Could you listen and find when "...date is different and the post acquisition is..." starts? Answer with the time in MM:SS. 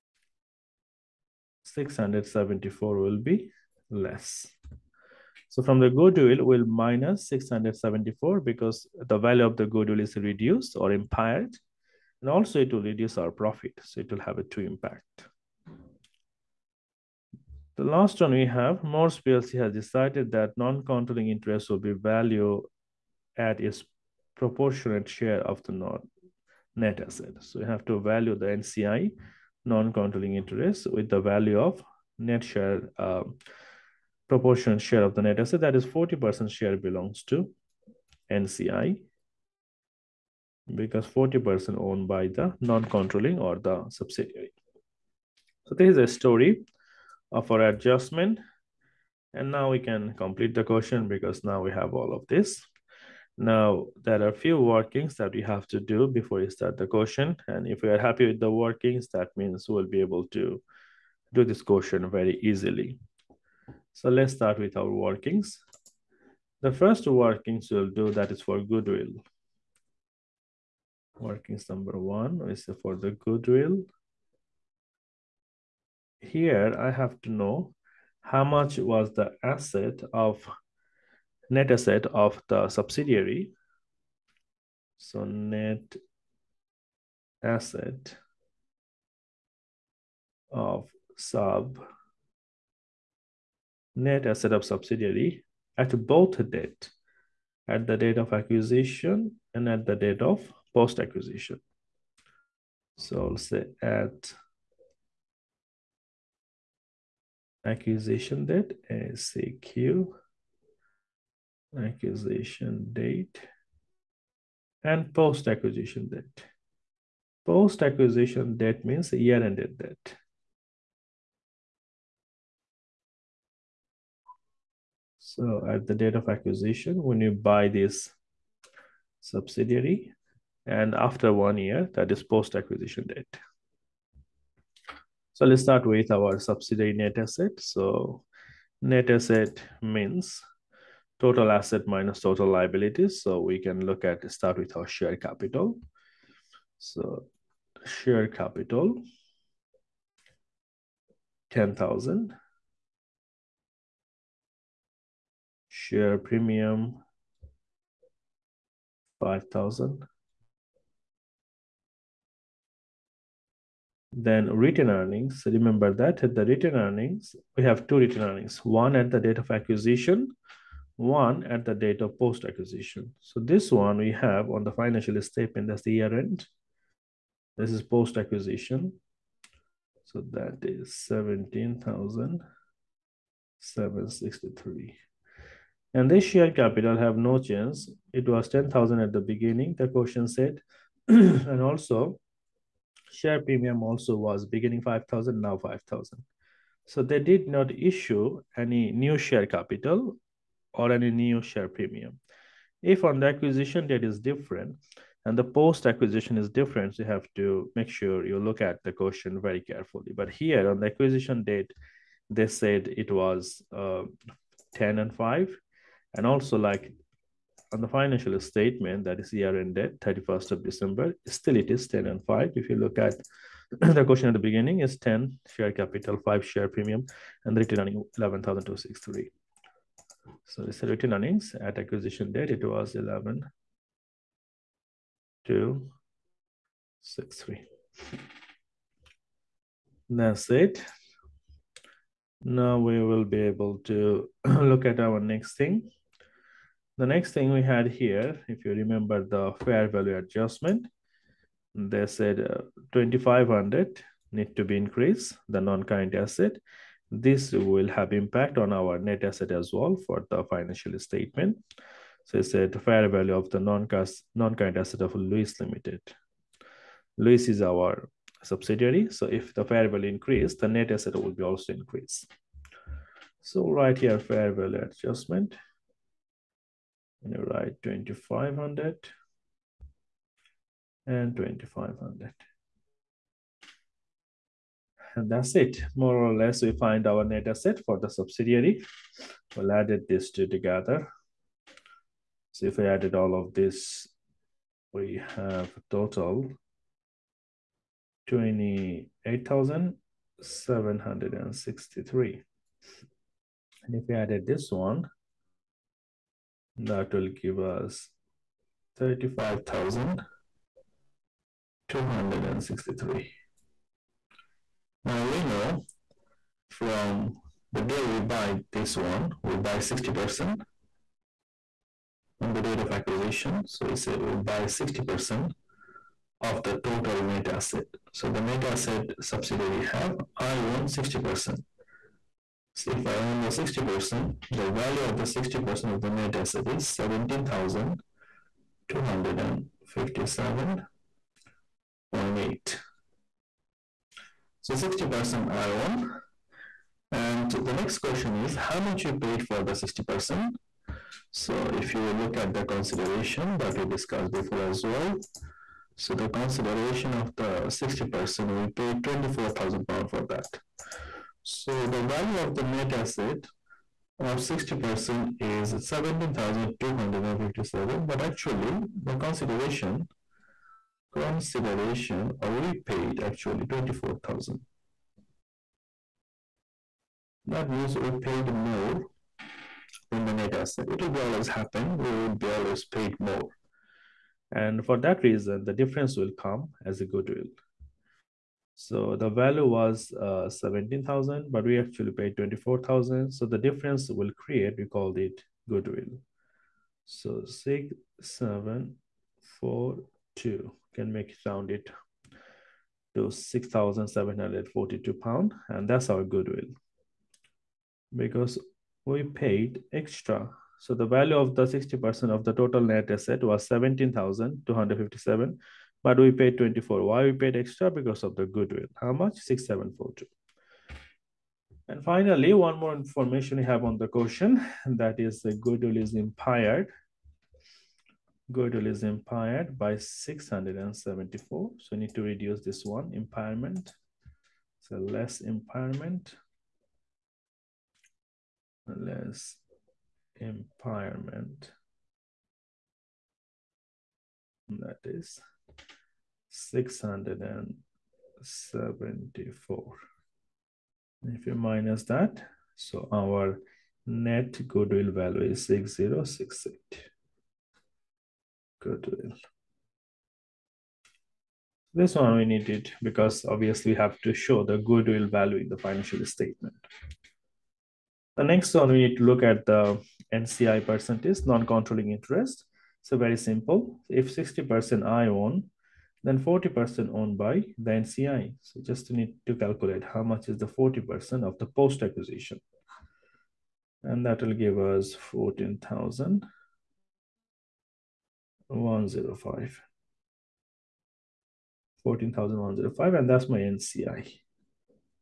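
03:23.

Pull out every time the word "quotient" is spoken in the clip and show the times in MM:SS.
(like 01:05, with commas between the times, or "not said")
00:56, 01:01.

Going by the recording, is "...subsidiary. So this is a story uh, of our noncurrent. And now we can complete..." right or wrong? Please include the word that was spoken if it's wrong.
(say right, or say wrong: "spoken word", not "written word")
wrong: "adjustment", not "noncurrent".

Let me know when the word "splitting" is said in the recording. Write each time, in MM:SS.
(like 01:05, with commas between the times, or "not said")
not said.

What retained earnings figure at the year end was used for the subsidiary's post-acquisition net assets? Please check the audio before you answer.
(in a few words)
17,763.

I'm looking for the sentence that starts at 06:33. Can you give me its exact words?
So the difference will create, we called it goodwill.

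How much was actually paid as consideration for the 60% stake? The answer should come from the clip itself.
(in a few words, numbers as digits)
24,000 pounds.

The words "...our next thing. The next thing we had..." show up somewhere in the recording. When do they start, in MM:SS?
04:05.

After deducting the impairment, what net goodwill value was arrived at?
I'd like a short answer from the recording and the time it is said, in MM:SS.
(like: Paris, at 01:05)
6068, at 07:35.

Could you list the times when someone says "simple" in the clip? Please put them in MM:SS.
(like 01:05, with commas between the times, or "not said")
07:53.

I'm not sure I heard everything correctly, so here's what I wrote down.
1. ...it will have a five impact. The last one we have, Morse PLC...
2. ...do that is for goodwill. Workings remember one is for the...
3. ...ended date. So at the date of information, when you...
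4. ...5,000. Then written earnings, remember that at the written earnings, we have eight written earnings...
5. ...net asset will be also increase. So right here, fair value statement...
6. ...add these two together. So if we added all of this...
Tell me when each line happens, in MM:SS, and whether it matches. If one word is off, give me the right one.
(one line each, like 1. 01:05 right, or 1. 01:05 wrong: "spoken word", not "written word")
1. 00:14 wrong: "two", not "five"
2. 01:07 wrong: "number", not "remember"
3. 01:59 wrong: "acquisition", not "information"
4. 02:39 wrong: "two", not "eight"
5. 04:30 wrong: "adjustment", not "statement"
6. 04:49 right.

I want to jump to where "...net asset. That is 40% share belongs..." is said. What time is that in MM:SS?
00:35.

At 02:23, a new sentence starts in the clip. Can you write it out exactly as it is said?
So we can look at start with our share capital.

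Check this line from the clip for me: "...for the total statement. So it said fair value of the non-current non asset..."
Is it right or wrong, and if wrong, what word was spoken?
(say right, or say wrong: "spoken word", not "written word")
wrong: "financial", not "total".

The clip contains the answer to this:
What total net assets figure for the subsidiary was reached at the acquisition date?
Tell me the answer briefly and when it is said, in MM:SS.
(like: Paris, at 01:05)
28,763, at 04:58.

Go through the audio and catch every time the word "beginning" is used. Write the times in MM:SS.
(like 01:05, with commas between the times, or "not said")
03:09, 03:14, 03:44.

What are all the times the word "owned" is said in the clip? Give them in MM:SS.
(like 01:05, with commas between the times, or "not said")
00:41, 07:57.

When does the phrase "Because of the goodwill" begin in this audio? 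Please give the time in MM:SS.
06:57.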